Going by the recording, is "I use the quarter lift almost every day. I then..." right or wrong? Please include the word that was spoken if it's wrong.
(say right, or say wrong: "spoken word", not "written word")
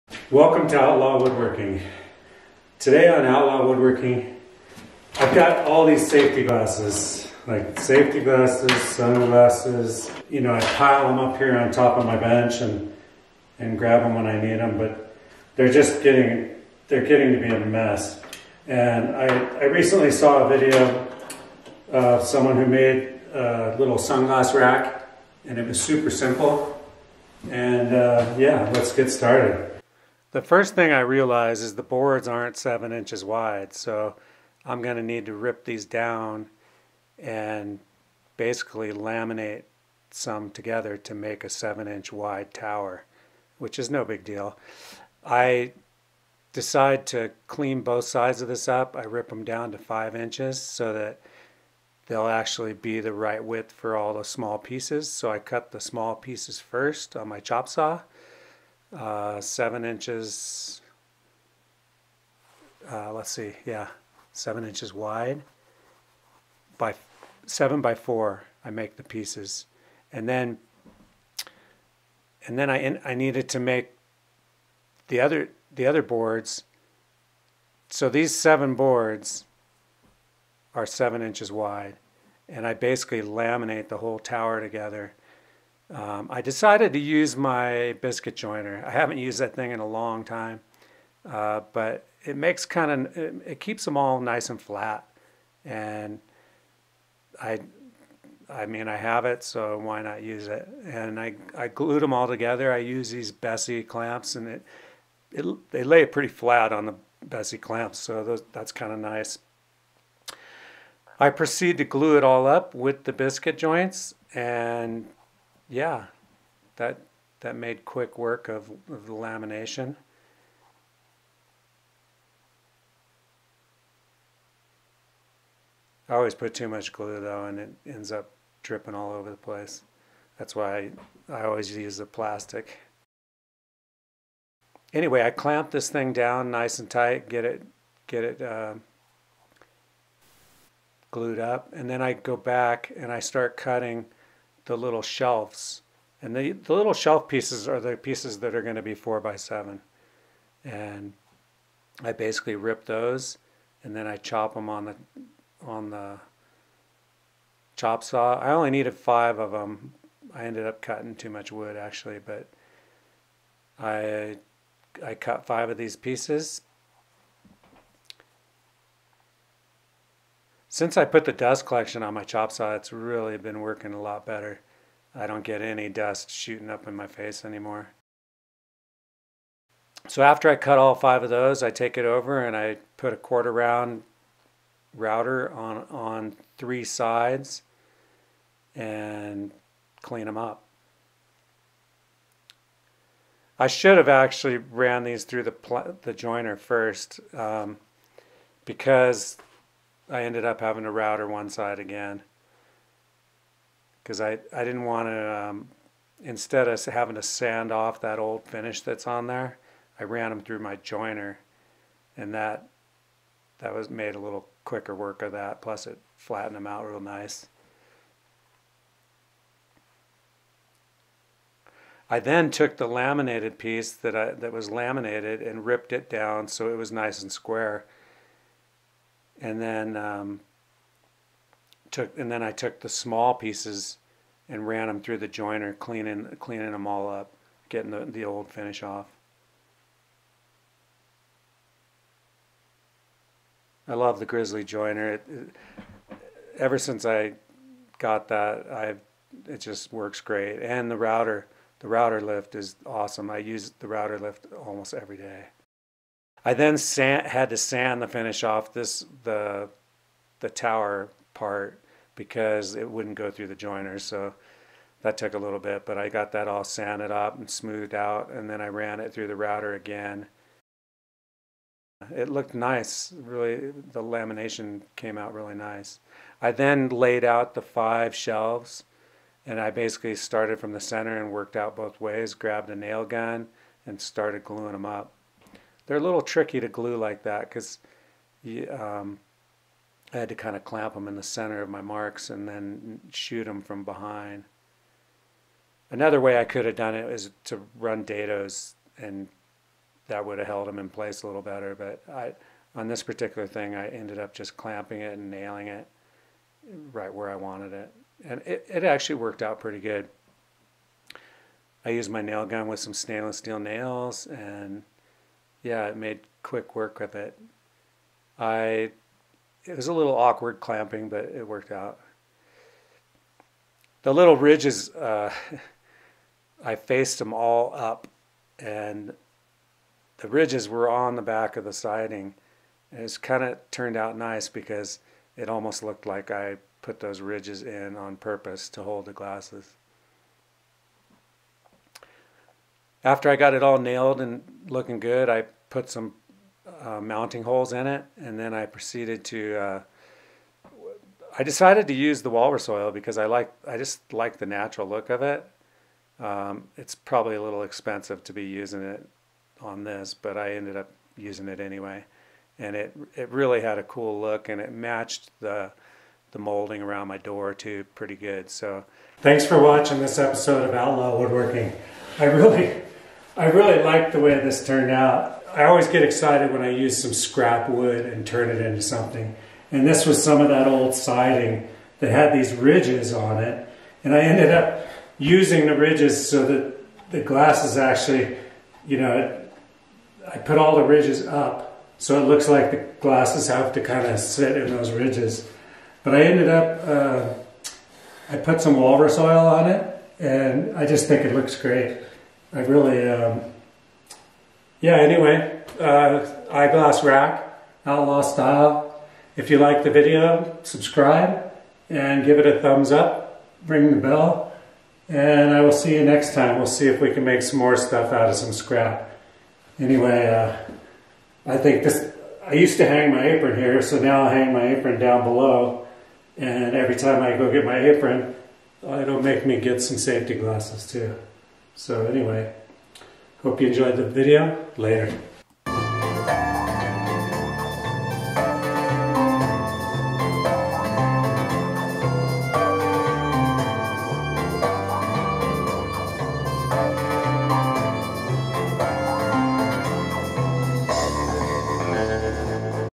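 wrong: "router", not "quarter".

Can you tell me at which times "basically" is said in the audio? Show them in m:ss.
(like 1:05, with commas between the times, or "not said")
0:38, 1:22, 2:32, 4:39.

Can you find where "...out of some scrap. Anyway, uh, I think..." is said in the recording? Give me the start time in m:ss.
6:58.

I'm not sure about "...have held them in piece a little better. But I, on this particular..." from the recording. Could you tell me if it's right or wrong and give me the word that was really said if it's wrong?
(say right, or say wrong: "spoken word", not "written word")
wrong: "place", not "piece".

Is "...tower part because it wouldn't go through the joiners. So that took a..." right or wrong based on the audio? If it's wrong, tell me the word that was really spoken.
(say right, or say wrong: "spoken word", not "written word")
right.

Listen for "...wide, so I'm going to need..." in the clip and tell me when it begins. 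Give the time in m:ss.
0:33.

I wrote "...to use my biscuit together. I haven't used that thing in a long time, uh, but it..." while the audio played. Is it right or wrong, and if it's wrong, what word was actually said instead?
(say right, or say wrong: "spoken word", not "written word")
wrong: "joiner", not "together".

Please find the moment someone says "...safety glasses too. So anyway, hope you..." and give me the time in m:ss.
7:09.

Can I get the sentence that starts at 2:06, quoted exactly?
I always put too much glue though and it ends up dripping all over the place.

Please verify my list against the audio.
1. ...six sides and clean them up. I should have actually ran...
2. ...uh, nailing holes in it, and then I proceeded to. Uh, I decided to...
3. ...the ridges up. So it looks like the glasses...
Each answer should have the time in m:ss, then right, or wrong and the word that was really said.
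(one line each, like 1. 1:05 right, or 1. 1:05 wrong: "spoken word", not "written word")
1. 3:06 wrong: "three", not "six"
2. 5:46 wrong: "mounting", not "nailing"
3. 6:30 right.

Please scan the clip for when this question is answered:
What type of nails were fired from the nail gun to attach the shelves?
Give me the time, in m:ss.
5:12.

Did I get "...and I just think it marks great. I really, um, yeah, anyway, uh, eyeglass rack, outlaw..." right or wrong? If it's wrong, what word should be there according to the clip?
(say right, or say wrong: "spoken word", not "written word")
wrong: "looks", not "marks".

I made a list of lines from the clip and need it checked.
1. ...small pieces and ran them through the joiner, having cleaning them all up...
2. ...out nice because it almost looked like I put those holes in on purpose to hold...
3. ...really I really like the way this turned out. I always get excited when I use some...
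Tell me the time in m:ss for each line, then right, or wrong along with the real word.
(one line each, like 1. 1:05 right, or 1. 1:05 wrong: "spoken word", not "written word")
1. 3:52 wrong: "cleaning", not "having"
2. 5:33 wrong: "ridges", not "holes"
3. 6:12 right.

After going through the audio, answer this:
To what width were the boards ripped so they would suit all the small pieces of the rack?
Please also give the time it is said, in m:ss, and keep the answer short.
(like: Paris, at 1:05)
5 inches, at 0:49.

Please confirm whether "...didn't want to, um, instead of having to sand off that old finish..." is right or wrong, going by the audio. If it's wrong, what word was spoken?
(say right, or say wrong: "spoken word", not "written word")
right.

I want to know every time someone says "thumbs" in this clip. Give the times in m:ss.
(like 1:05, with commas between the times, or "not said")
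6:52.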